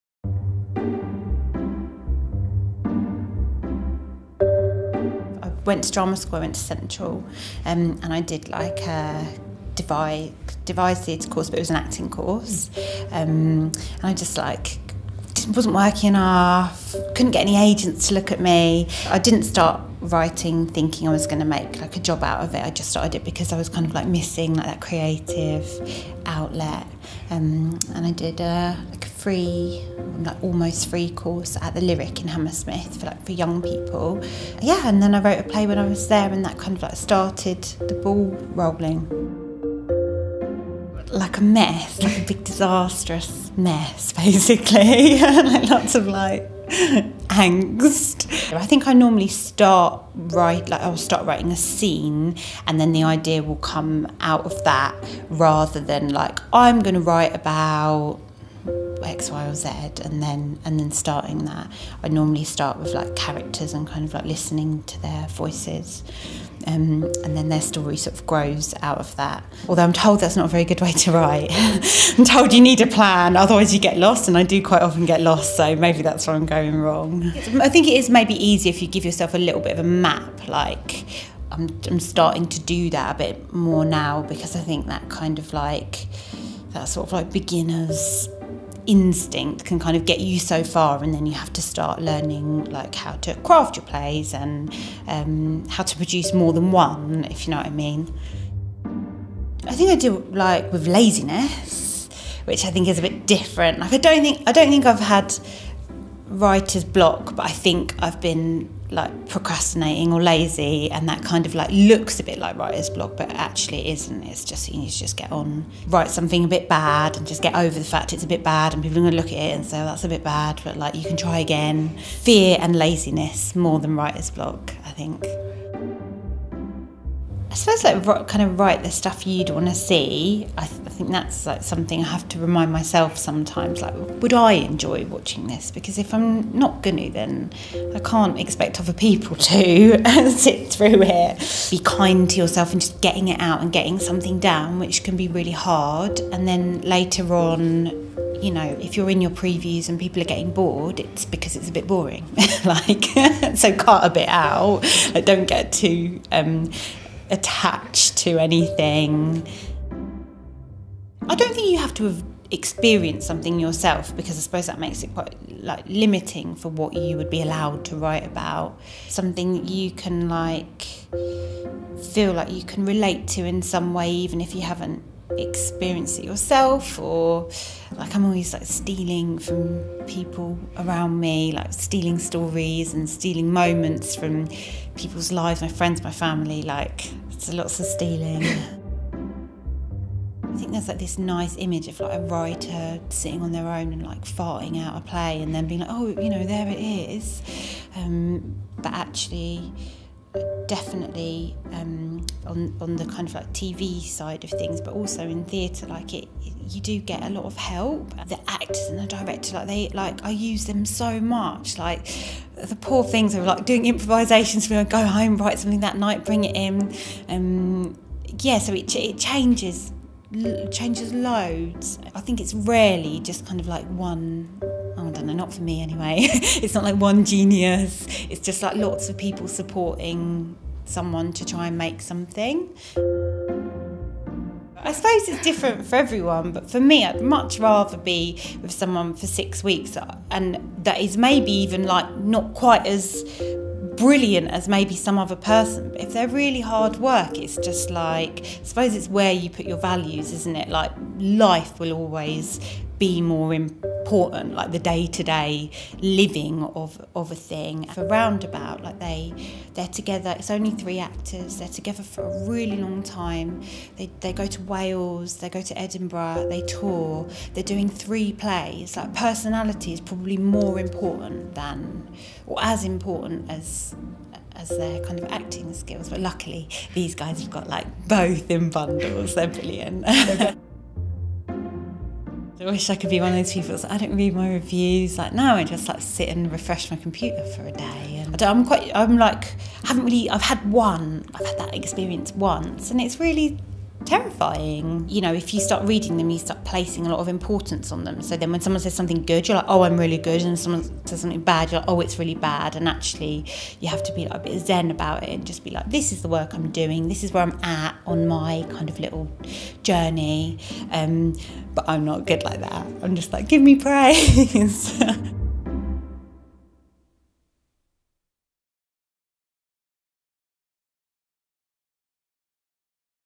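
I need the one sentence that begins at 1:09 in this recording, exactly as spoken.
Although I'm told that's not a very good way to write.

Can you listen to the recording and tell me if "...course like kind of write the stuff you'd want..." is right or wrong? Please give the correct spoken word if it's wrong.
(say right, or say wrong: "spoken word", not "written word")
wrong: "suppose", not "course".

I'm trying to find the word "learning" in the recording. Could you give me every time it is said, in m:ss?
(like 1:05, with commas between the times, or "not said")
1:32.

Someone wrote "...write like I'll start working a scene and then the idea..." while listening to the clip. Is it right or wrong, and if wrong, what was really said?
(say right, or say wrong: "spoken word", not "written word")
wrong: "writing", not "working".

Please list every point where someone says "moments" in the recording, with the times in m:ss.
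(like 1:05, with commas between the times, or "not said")
3:03.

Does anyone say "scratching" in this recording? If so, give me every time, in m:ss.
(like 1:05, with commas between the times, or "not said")
not said.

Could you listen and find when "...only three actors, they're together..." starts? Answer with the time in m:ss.
4:20.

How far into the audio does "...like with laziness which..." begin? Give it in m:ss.
1:40.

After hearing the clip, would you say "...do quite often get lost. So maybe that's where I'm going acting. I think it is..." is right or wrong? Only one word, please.
wrong.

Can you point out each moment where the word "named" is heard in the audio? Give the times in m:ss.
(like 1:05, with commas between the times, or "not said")
not said.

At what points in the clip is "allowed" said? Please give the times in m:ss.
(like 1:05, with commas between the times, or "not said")
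2:47.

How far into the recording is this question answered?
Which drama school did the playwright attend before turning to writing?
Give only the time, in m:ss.
0:06.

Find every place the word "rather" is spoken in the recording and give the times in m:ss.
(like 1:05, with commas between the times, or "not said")
0:55, 3:57.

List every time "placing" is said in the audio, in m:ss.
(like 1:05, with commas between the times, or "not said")
4:56.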